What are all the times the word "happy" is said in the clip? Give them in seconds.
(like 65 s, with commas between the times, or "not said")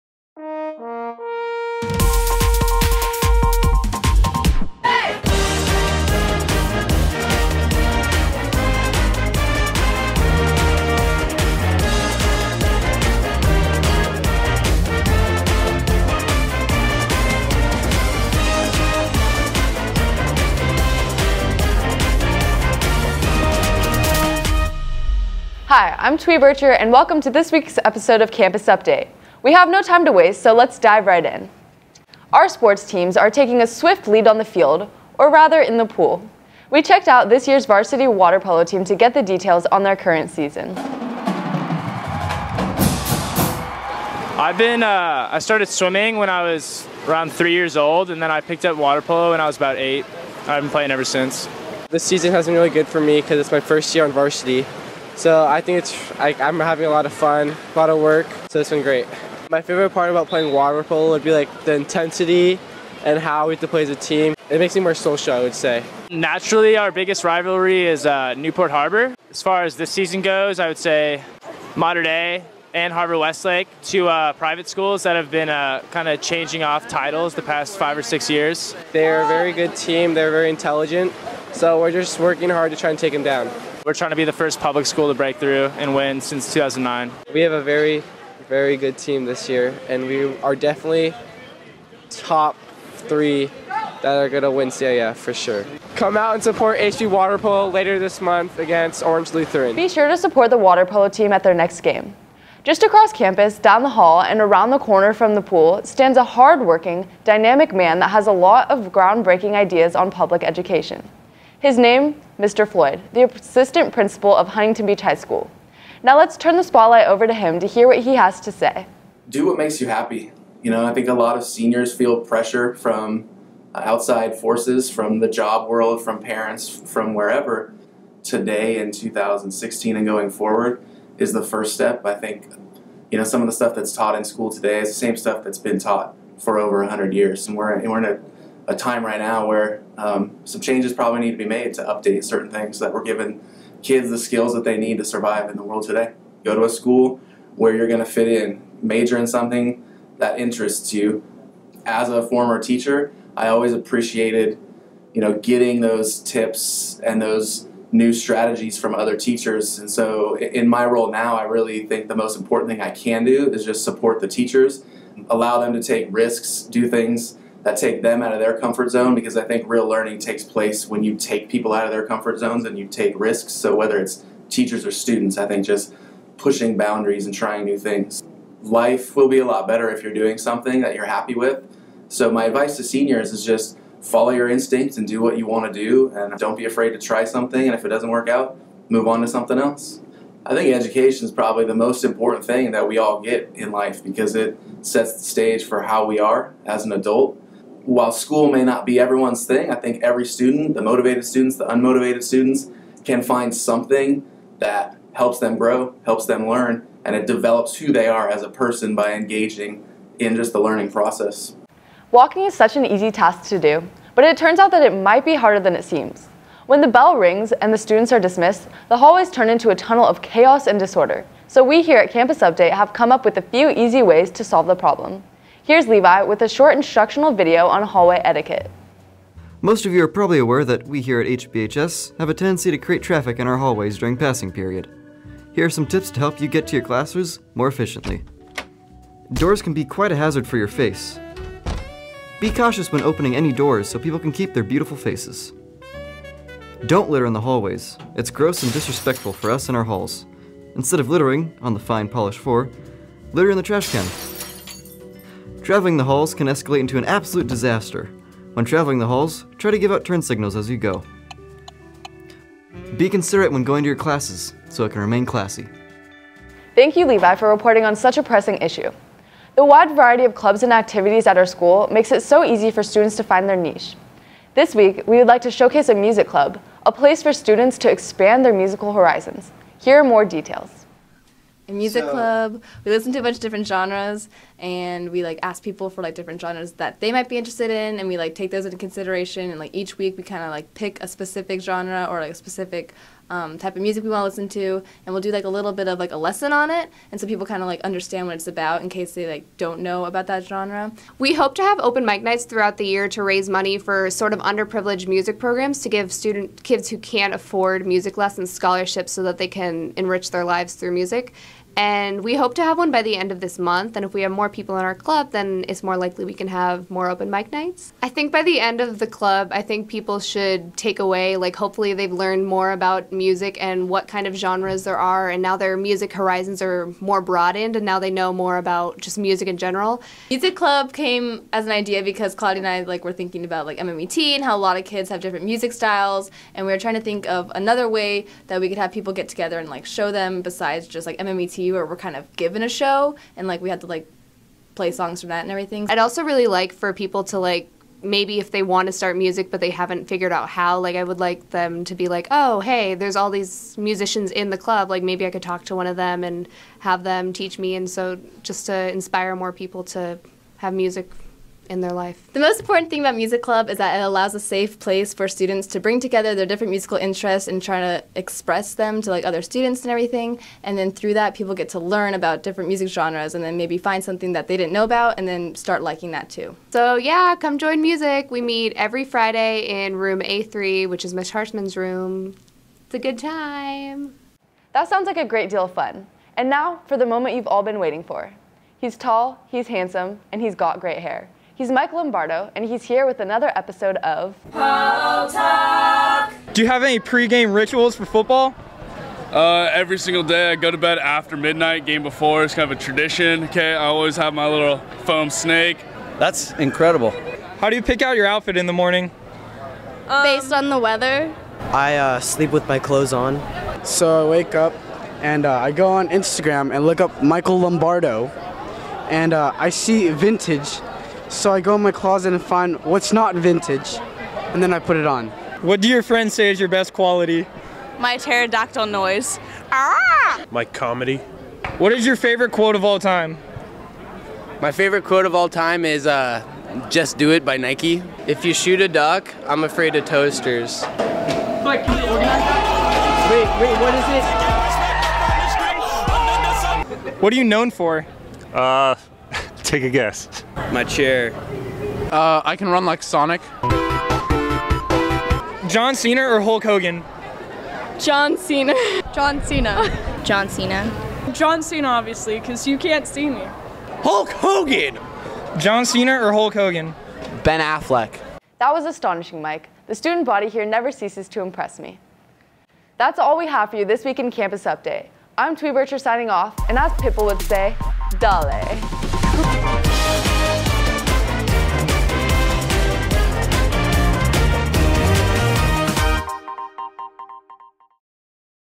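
119 s, 181 s.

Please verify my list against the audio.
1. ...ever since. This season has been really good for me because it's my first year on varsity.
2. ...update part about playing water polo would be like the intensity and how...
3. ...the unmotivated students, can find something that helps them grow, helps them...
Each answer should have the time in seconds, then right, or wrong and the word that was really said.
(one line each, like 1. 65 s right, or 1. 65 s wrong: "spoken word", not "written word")
1. 50 s right
2. 59 s wrong: "favorite", not "update"
3. 201 s right.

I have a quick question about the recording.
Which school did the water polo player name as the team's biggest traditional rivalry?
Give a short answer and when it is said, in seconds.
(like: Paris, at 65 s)
Newport Harbor, at 68 s.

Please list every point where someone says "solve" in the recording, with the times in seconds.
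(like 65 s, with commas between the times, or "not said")
224 s.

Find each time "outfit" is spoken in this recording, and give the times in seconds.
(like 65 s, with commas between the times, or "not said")
408 s.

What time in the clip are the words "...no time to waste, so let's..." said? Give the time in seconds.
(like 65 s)
29 s.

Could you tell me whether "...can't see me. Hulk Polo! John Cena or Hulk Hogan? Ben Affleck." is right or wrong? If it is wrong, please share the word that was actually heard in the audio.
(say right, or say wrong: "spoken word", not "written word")
wrong: "Hogan", not "Polo".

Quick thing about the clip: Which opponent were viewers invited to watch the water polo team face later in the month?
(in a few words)
Orange Lutheran.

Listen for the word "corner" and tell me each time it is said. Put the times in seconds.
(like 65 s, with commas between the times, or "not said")
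104 s.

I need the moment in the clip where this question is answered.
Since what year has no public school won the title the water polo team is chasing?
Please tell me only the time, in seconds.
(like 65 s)
86 s.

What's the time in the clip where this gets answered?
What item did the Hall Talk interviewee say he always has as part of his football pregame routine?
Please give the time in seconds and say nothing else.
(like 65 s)
405 s.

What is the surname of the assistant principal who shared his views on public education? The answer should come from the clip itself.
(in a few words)
Floyd.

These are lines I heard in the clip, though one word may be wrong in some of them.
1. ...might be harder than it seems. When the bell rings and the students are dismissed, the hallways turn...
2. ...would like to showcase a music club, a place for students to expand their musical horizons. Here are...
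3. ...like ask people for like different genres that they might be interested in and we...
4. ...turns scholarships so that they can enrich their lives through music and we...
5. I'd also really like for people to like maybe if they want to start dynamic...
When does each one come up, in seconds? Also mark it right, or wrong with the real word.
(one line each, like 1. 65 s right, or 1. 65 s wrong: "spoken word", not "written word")
1. 214 s right
2. 275 s right
3. 285 s right
4. 308 s wrong: "lessons", not "turns"
5. 345 s wrong: "music", not "dynamic".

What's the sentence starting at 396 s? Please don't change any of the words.
Do you have any pregame rituals for football?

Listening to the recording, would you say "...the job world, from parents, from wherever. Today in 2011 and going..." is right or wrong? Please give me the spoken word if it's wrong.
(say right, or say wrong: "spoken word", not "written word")
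wrong: "2016", not "2011".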